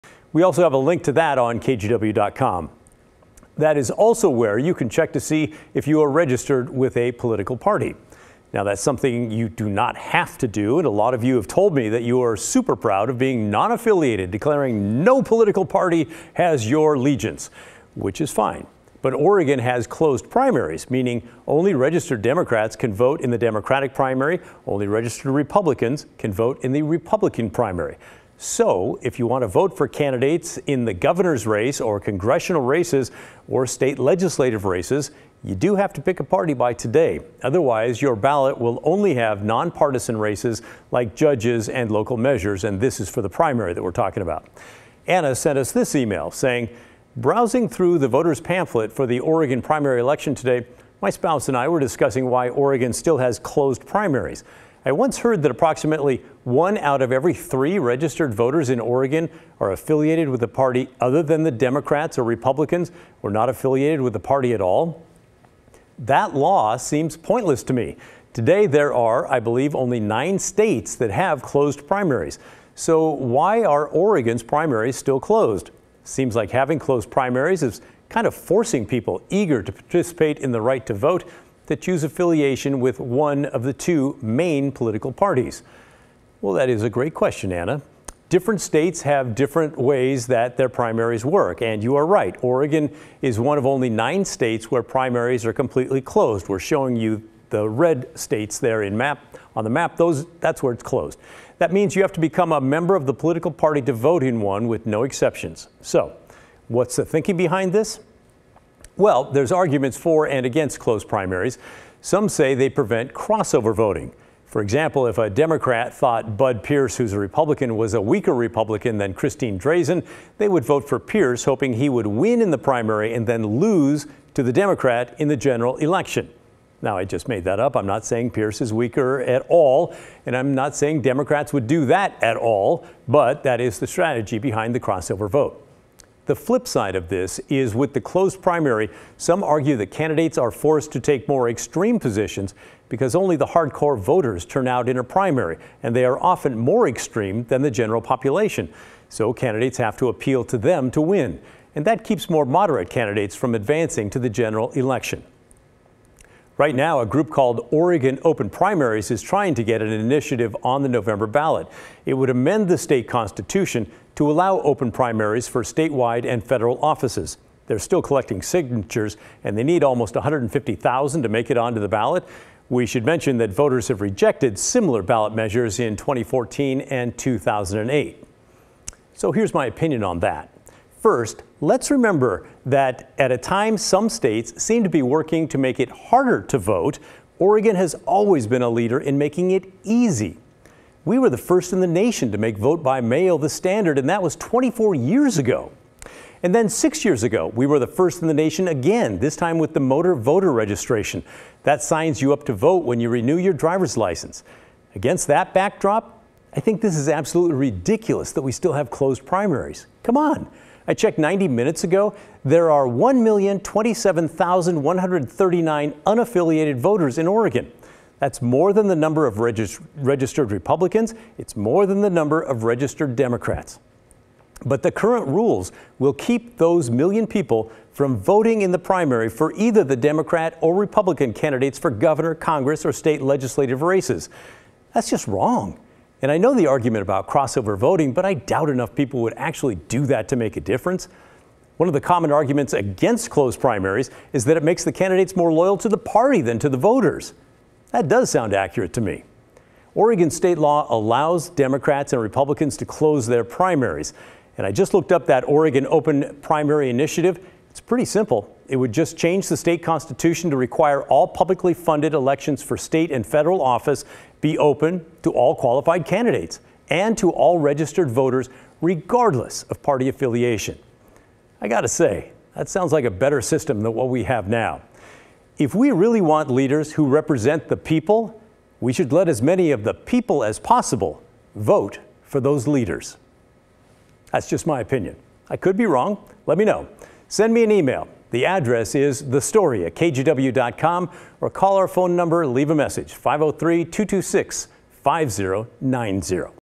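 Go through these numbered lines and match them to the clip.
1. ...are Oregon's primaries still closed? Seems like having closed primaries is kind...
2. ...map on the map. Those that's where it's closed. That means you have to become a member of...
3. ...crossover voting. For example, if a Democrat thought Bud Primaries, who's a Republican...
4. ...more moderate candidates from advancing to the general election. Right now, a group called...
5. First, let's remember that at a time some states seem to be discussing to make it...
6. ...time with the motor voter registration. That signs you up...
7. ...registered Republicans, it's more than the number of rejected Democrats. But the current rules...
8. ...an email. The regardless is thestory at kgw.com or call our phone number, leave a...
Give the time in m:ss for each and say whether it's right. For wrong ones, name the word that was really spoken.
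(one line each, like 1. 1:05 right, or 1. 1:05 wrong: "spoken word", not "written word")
1. 1:13 right
2. 1:38 right
3. 1:53 wrong: "Pierce", not "Primaries"
4. 2:32 right
5. 3:00 wrong: "working", not "discussing"
6. 3:19 right
7. 3:39 wrong: "registered", not "rejected"
8. 4:47 wrong: "address", not "regardless".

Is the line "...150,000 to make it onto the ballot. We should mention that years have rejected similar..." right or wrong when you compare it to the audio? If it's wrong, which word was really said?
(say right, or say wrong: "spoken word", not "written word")
wrong: "voters", not "years".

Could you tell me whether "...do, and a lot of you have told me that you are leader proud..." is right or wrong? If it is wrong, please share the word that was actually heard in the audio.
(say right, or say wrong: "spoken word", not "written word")
wrong: "super", not "leader".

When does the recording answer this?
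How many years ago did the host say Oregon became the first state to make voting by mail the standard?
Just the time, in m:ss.
3:14.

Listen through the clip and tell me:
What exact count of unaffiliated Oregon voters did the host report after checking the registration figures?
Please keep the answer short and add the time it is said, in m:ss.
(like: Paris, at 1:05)
1,027,139, at 3:32.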